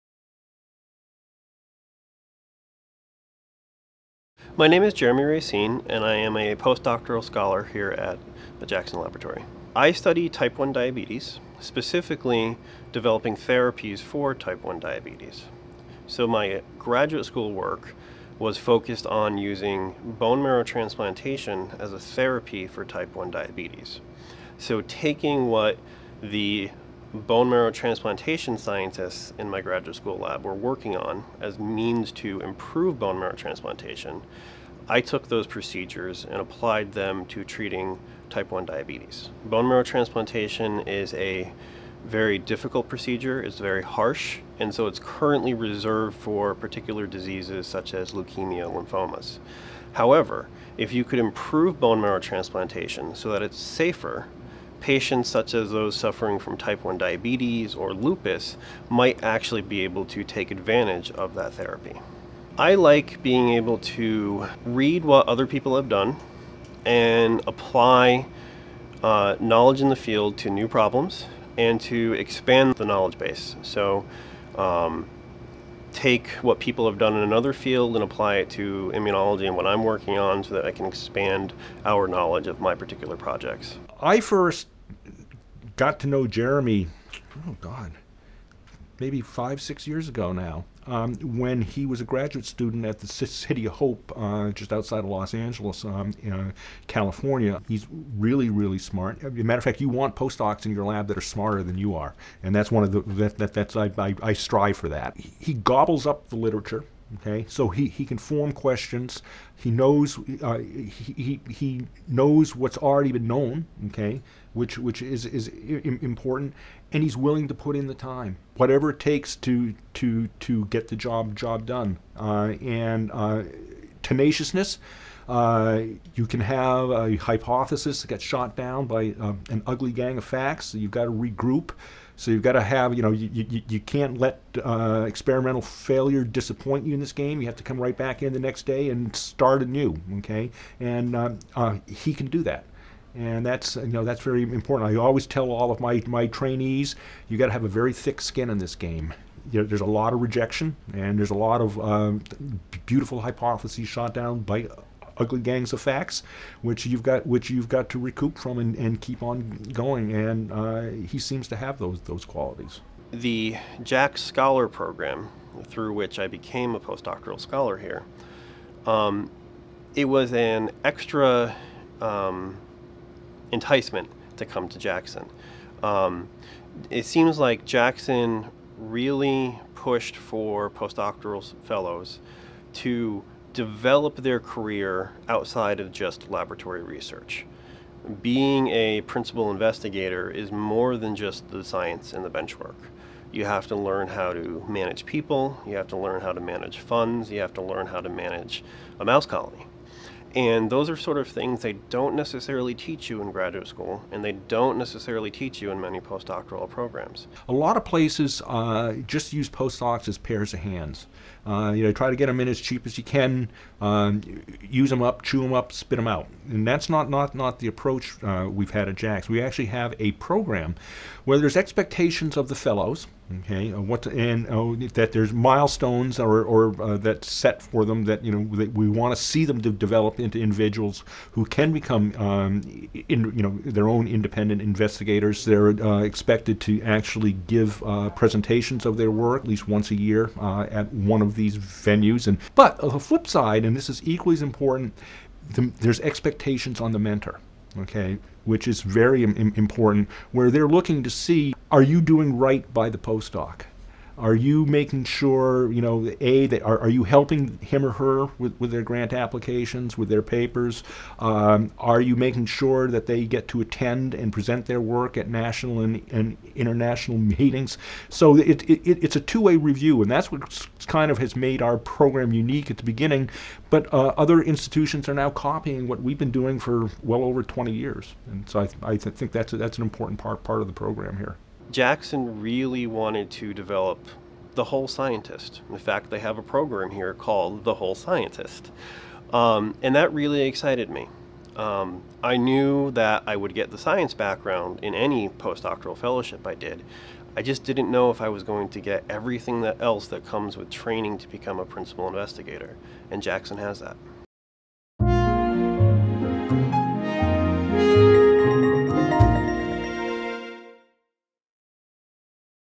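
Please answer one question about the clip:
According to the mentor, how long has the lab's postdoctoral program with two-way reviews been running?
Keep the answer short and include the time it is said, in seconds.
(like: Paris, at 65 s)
over 20 years, at 277 s.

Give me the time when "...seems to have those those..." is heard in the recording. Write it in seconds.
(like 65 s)
161 s.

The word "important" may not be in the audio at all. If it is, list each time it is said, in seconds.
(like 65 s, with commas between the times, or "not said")
115 s, 144 s, 244 s, 249 s, 279 s.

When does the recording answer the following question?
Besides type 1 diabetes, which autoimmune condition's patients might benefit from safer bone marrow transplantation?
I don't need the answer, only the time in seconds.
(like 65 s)
57 s.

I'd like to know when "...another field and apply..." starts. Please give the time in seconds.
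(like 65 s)
77 s.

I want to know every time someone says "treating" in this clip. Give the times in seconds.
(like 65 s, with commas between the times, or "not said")
37 s.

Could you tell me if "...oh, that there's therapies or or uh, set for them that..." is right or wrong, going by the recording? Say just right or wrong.
wrong.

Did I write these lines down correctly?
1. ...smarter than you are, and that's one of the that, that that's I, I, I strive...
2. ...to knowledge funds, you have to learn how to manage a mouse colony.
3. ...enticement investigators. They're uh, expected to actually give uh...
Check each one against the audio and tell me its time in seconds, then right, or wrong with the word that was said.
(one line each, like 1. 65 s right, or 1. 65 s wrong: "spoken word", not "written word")
1. 101 s right
2. 196 s wrong: "manage", not "knowledge"
3. 234 s wrong: "independent", not "enticement".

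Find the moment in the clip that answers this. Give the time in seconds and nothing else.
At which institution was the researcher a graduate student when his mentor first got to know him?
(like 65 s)
93 s.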